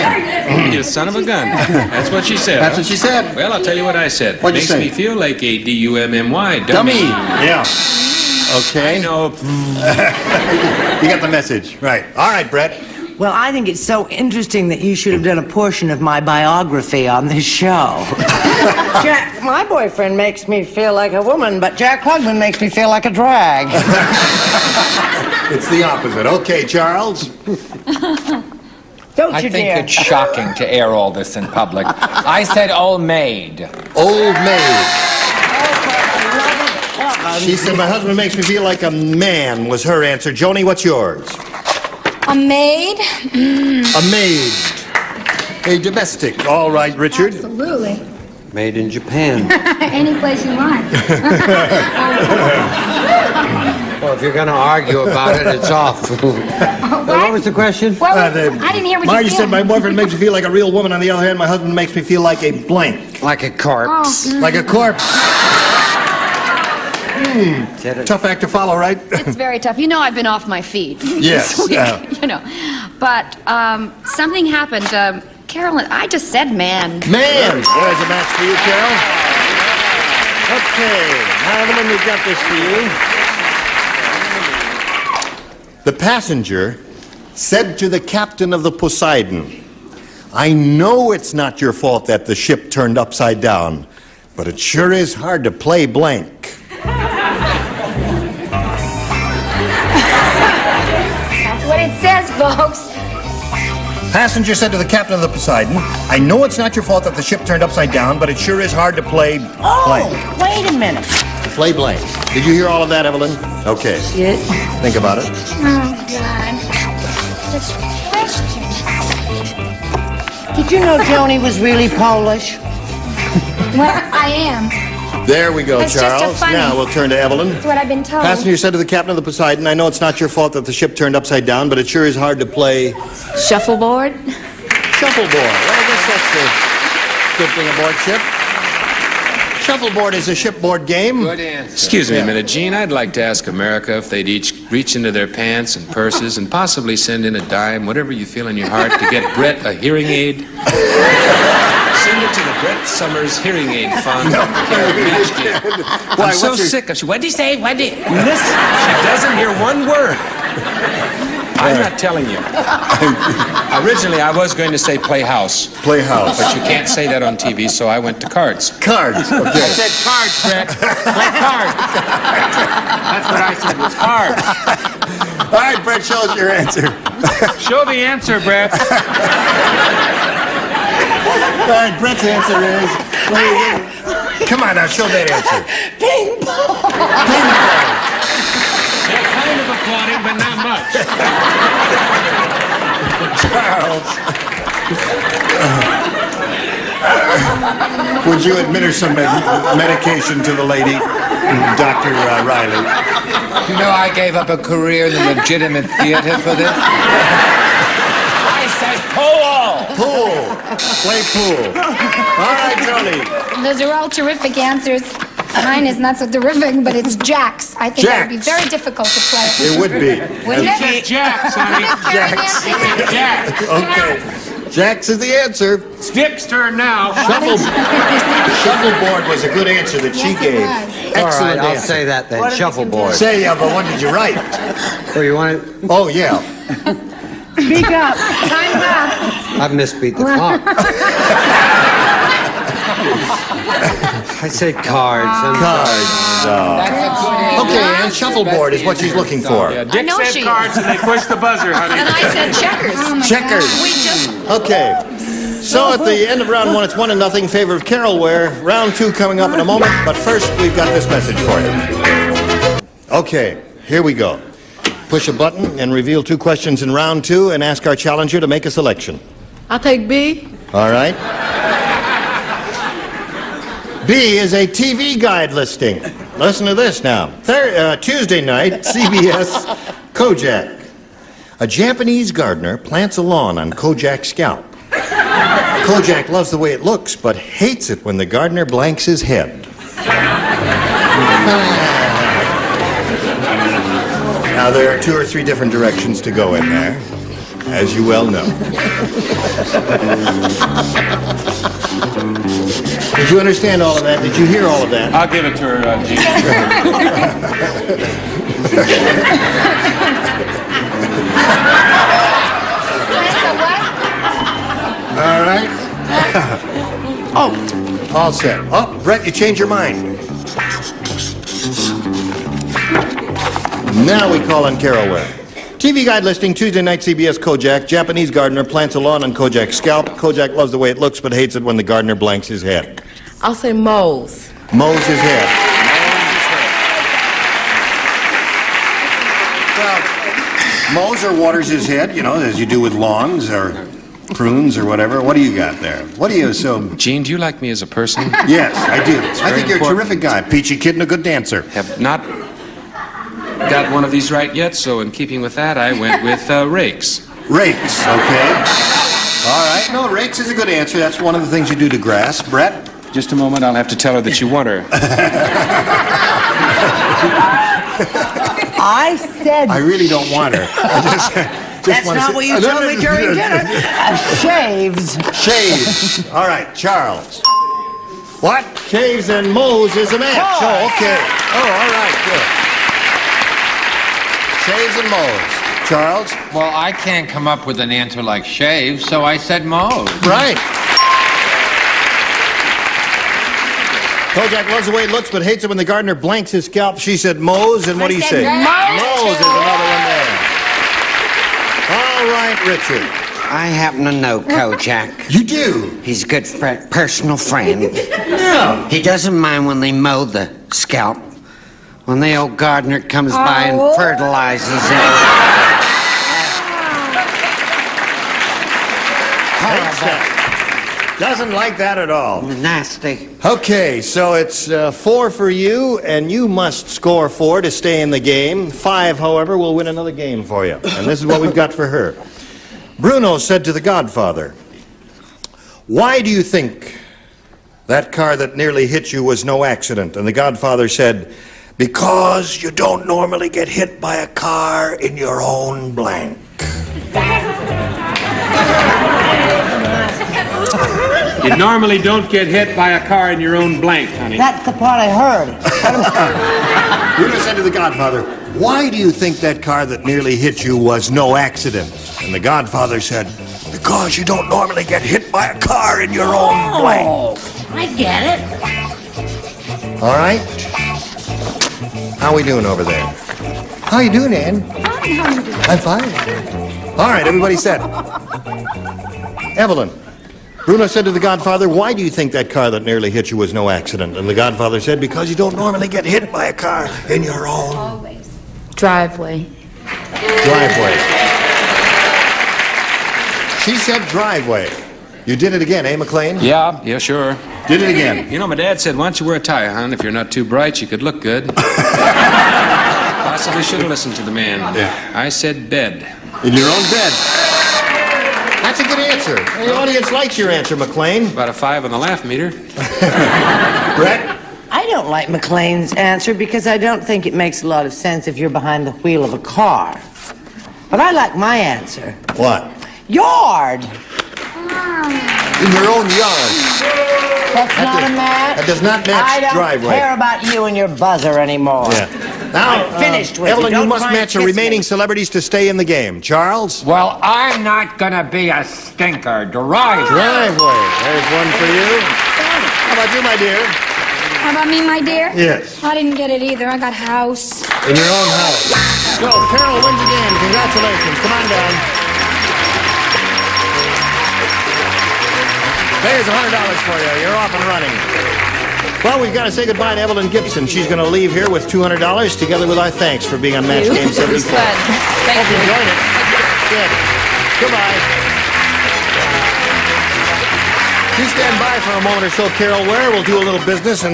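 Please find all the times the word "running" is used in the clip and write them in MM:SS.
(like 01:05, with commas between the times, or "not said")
09:17.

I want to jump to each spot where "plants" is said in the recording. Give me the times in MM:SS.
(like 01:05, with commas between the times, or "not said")
04:42, 05:28.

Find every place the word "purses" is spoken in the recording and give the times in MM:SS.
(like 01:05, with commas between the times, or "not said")
02:25.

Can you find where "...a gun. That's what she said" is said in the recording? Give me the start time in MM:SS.
00:01.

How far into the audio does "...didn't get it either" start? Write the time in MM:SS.
09:05.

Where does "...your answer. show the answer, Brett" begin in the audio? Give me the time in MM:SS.
02:56.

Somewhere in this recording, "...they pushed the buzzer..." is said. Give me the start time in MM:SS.
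04:10.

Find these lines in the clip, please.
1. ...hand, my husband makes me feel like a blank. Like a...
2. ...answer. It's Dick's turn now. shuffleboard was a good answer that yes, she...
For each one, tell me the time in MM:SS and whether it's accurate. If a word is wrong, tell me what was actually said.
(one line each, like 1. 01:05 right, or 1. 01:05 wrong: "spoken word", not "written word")
1. 01:01 right
2. 03:45 right.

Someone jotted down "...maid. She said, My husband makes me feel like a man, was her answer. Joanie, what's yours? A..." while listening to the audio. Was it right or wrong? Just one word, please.
right.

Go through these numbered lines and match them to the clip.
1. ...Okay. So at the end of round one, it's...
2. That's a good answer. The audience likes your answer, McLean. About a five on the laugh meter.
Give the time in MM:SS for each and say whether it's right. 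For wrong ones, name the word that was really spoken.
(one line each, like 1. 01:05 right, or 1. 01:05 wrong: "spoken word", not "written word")
1. 04:14 right
2. 08:28 right.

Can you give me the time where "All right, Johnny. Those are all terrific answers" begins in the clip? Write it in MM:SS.
03:31.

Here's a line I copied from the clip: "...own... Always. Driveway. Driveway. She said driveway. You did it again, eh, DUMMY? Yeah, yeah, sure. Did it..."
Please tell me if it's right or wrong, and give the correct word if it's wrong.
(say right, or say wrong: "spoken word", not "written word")
wrong: "McLean", not "DUMMY".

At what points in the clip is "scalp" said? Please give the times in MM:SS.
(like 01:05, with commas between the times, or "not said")
04:44, 05:29, 06:36, 06:50.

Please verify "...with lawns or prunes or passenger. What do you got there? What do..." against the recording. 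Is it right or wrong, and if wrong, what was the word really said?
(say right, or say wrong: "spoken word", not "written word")
wrong: "whatever", not "passenger".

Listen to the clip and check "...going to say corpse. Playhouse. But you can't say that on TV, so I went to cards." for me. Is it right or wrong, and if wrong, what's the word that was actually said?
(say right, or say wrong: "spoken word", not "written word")
wrong: "playhouse", not "corpse".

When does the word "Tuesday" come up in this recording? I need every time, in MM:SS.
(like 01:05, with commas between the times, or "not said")
04:37, 05:26.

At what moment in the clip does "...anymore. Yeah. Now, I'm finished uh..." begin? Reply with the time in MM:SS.
08:51.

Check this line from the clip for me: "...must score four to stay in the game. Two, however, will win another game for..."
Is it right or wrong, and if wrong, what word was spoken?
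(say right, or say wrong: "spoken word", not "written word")
wrong: "Five", not "Two".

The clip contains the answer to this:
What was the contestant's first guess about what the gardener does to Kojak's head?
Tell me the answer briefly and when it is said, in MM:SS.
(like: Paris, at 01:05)
Moles, at 05:33.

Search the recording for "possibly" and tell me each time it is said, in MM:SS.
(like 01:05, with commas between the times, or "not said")
02:26, 08:23.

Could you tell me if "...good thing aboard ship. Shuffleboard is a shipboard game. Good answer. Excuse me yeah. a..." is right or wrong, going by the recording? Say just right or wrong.
right.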